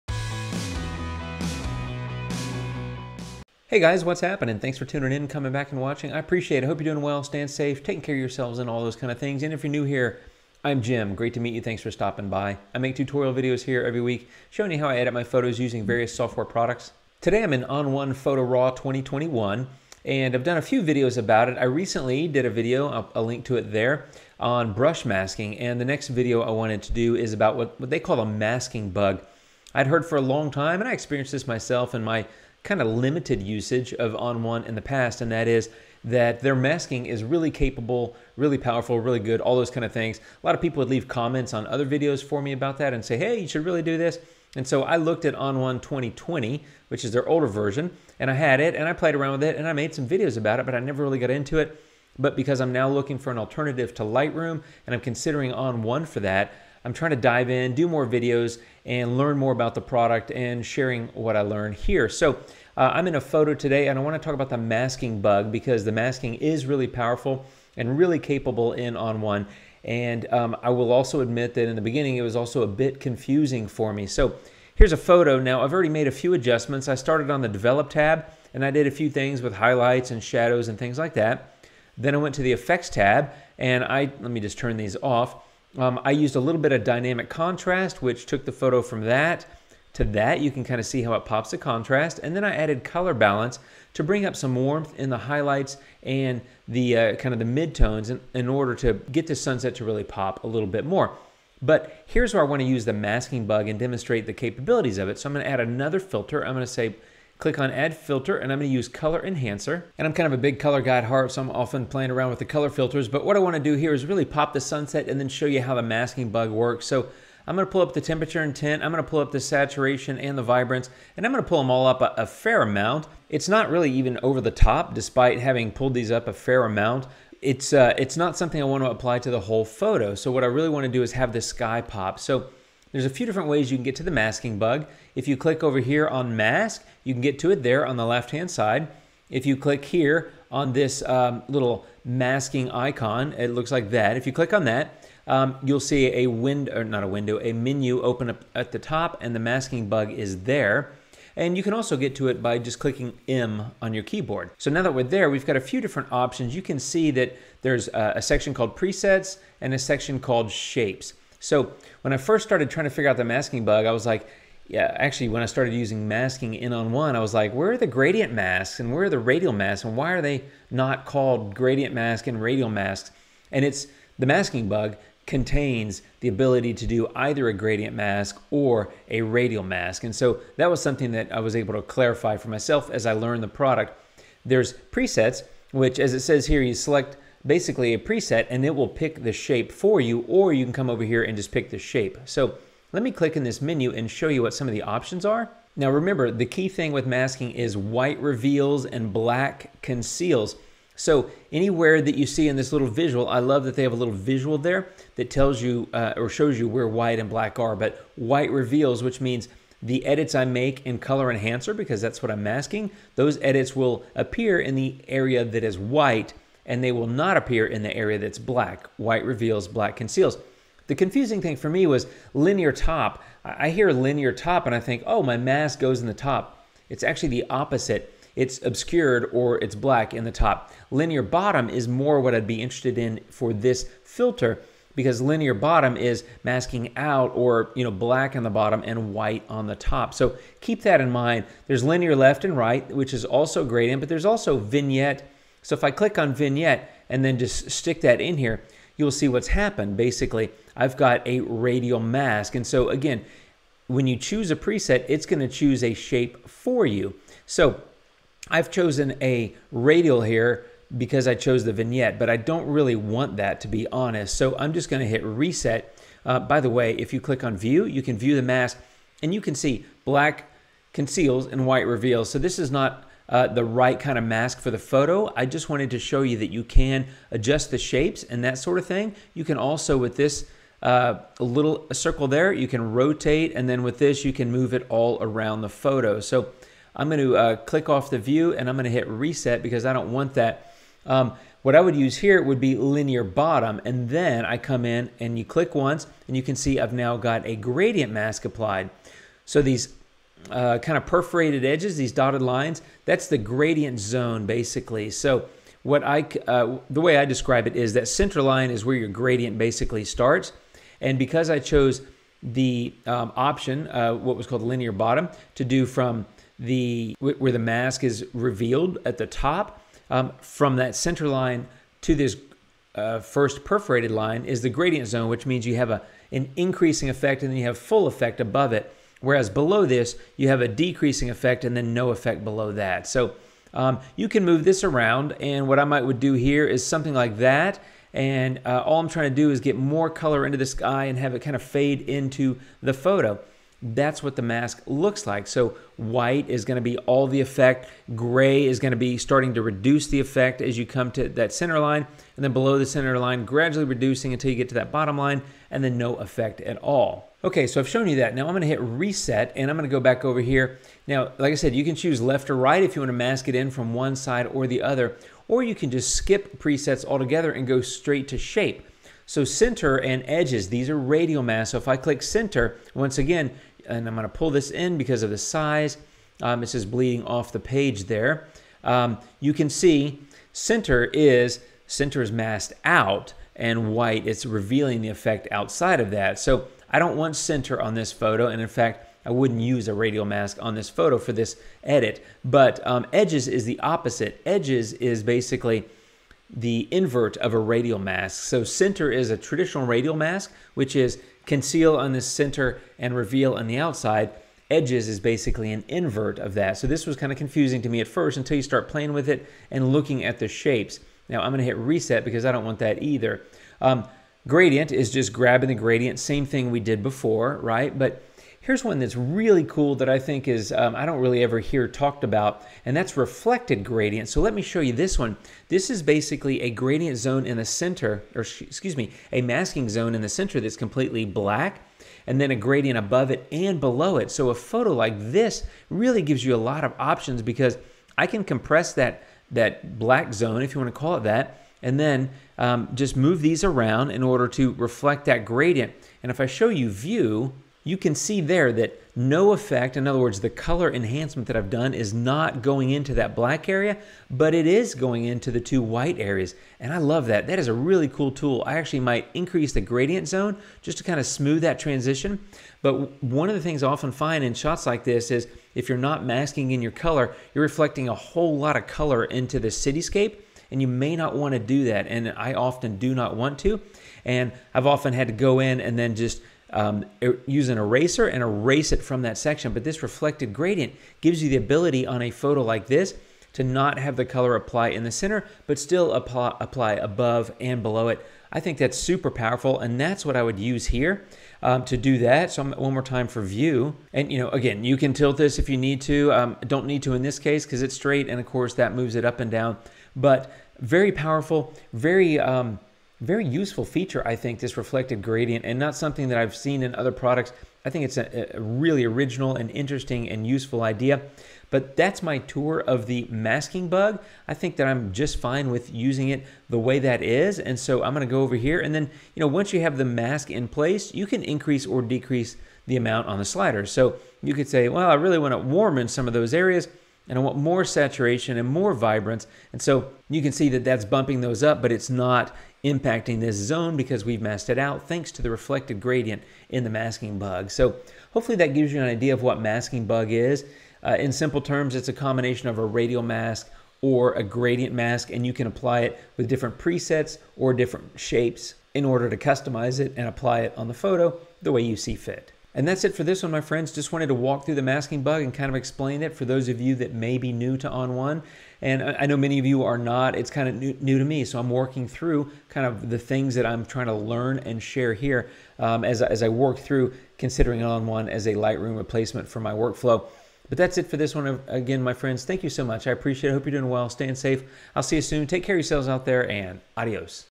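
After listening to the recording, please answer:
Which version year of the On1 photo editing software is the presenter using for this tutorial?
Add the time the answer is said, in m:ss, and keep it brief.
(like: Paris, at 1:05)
2021, at 0:17.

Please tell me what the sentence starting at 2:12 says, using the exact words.
So there's a few different ways you can get to the masking bug.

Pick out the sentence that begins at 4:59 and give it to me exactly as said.
So these uh, kind of perforated edges, these dotted lines, that's the gradient zone basically.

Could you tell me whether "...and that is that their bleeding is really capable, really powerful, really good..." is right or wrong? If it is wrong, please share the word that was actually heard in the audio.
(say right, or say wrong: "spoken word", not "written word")
wrong: "masking", not "bleeding".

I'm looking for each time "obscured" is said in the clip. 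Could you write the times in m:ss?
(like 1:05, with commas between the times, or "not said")
3:48.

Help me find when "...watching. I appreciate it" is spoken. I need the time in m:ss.
0:05.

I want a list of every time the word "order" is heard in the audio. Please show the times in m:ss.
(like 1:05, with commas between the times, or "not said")
1:38, 7:24, 9:09.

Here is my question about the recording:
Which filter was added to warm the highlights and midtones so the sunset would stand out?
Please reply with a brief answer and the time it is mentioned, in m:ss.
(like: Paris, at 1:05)
Color balance, at 1:32.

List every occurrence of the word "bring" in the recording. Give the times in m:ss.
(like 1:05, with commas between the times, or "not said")
1:34.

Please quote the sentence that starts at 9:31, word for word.
Again, my friends, thank you so much.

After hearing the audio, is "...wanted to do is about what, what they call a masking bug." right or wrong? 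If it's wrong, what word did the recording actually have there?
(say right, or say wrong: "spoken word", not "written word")
right.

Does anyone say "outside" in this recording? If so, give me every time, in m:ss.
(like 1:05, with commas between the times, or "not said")
6:25, 6:43.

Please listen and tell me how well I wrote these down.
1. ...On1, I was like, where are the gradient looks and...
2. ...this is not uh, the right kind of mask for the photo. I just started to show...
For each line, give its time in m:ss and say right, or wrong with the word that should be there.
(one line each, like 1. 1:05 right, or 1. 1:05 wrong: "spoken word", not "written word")
1. 2:46 wrong: "masks", not "looks"
2. 4:32 wrong: "wanted", not "started".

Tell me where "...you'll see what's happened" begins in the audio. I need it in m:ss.
4:09.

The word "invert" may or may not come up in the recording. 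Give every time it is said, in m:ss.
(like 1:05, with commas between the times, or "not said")
6:36, 6:45.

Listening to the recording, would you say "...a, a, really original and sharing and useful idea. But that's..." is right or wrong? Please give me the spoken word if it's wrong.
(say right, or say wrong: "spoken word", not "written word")
wrong: "interesting", not "sharing".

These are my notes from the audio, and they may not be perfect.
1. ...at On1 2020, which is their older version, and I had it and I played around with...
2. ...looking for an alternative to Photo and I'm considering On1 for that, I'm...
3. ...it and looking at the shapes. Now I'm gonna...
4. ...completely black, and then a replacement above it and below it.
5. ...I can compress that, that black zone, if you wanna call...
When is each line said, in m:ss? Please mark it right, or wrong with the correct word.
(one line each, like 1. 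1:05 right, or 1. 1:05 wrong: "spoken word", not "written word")
1. 0:45 right
2. 0:52 wrong: "Lightroom", not "Photo"
3. 6:49 right
4. 7:10 wrong: "gradient", not "replacement"
5. 7:18 right.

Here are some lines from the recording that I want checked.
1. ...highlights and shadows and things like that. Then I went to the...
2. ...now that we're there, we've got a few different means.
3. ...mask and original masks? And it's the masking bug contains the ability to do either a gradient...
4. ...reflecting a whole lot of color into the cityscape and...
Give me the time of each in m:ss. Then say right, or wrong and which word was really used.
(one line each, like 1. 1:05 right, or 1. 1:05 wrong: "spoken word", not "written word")
1. 1:19 right
2. 2:34 wrong: "options", not "means"
3. 2:51 wrong: "radial", not "original"
4. 7:47 right.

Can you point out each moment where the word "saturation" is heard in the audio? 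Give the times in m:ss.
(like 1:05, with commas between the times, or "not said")
1:59, 8:47.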